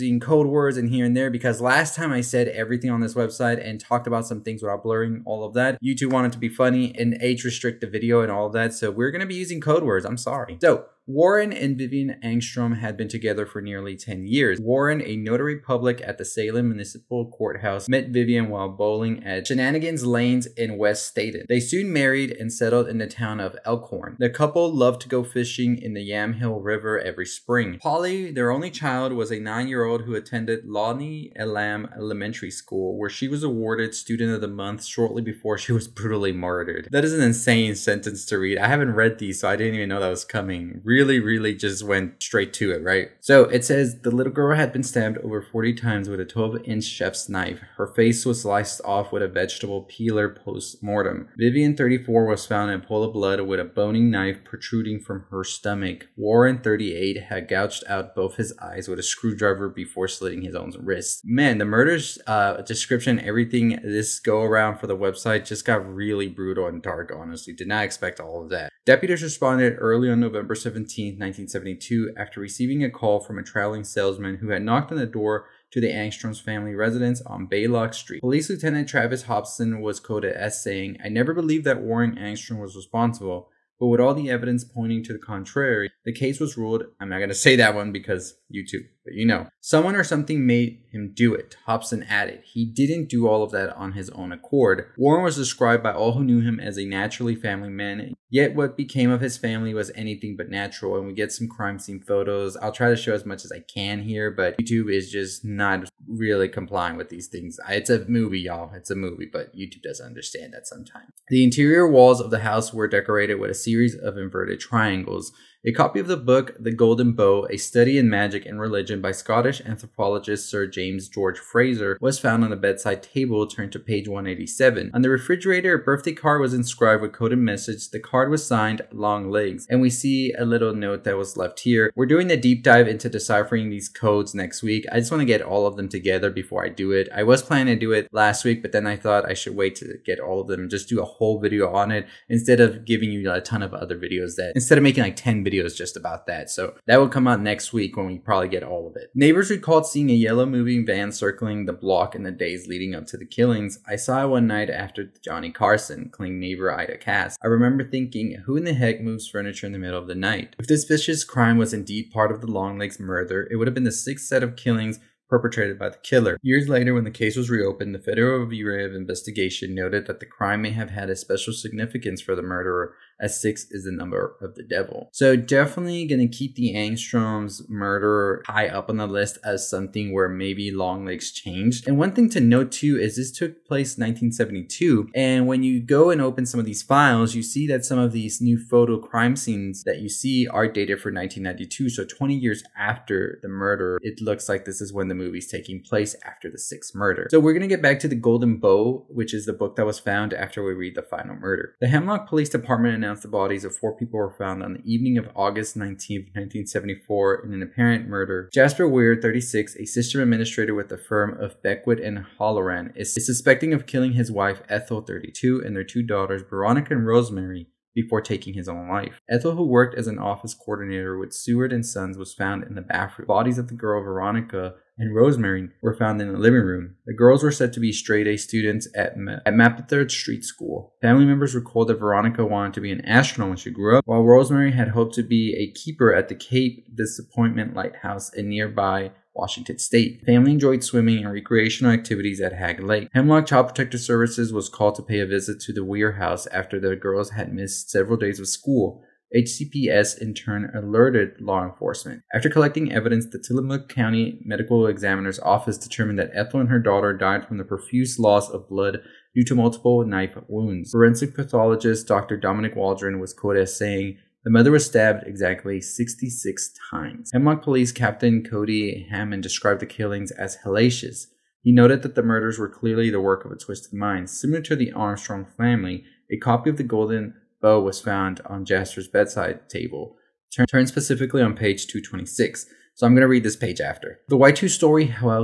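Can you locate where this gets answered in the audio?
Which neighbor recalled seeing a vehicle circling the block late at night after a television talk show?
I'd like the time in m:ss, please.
2:36.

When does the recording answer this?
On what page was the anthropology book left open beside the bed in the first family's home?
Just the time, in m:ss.
2:04.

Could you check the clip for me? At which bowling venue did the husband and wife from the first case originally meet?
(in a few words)
Shenanigans Lanes.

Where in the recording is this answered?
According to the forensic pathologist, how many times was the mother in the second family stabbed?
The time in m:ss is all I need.
4:25.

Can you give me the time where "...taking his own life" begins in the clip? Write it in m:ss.
3:38.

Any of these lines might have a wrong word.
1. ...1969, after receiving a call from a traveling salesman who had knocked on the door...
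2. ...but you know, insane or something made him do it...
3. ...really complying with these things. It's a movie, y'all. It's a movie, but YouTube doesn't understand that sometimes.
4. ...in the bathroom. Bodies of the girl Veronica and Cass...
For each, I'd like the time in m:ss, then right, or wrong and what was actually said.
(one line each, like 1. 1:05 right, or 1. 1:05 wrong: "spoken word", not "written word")
1. 1:11 wrong: "1972", not "1969"
2. 1:29 wrong: "someone", not "insane"
3. 1:46 right
4. 3:42 wrong: "Rosemary", not "Cass".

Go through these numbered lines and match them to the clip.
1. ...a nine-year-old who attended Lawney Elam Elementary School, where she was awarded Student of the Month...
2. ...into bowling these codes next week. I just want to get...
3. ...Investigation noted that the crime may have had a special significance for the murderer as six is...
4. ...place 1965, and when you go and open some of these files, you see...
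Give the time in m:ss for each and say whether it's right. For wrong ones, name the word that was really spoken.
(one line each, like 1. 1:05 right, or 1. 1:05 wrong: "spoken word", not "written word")
1. 0:29 right
2. 2:12 wrong: "deciphering", not "bowling"
3. 2:48 right
4. 3:03 wrong: "1972", not "1965".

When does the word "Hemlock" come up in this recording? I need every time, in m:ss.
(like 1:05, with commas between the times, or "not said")
3:21, 4:03, 4:27.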